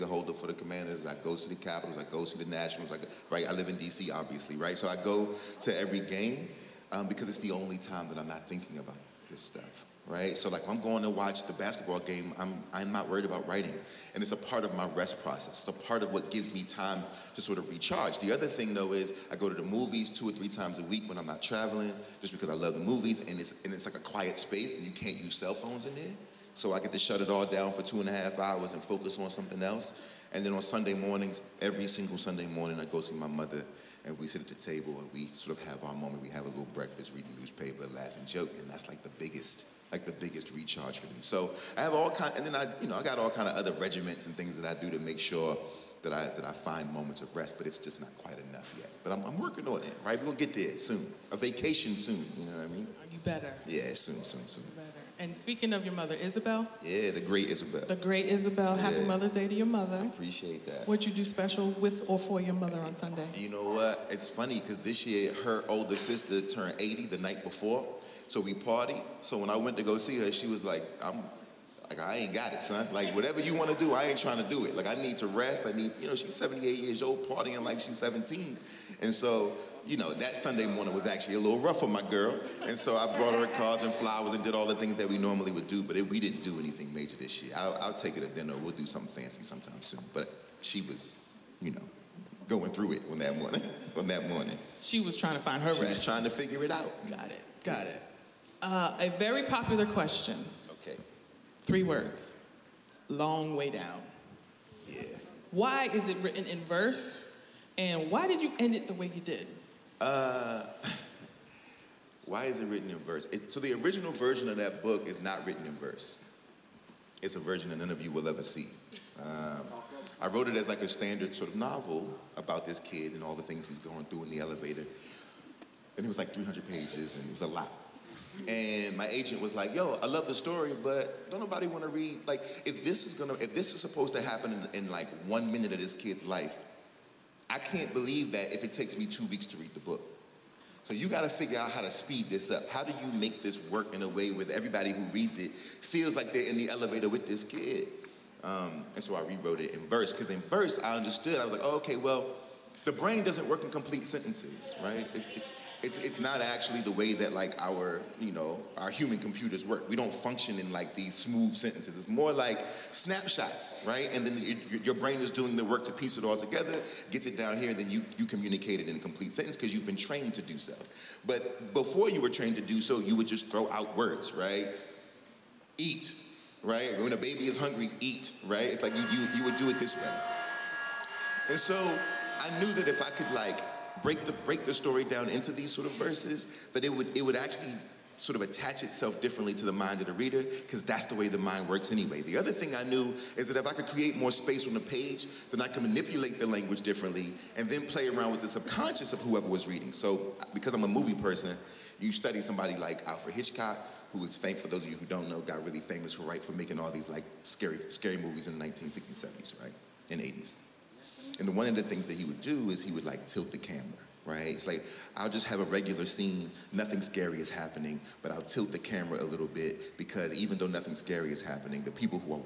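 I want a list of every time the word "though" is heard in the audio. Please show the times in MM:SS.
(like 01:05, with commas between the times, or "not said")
00:18, 03:40.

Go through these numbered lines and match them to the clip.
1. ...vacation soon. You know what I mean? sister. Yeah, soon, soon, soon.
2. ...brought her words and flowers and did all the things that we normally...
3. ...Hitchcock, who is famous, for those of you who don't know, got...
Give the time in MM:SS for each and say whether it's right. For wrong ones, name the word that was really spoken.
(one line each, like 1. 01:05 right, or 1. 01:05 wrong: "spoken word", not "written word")
1. 00:51 wrong: "better", not "sister"
2. 01:23 wrong: "cards", not "words"
3. 03:23 right.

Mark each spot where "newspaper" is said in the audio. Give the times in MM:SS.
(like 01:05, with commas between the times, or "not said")
00:37.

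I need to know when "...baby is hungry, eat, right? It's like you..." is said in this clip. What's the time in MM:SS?
02:57.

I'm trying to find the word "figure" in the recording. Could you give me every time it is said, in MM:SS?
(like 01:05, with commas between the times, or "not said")
01:36, 02:21.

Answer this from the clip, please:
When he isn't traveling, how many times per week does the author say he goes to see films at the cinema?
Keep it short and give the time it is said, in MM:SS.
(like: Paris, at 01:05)
2 or 3, at 00:20.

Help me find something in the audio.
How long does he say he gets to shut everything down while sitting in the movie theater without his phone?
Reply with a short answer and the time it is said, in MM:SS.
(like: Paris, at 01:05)
2 and a half hours, at 00:27.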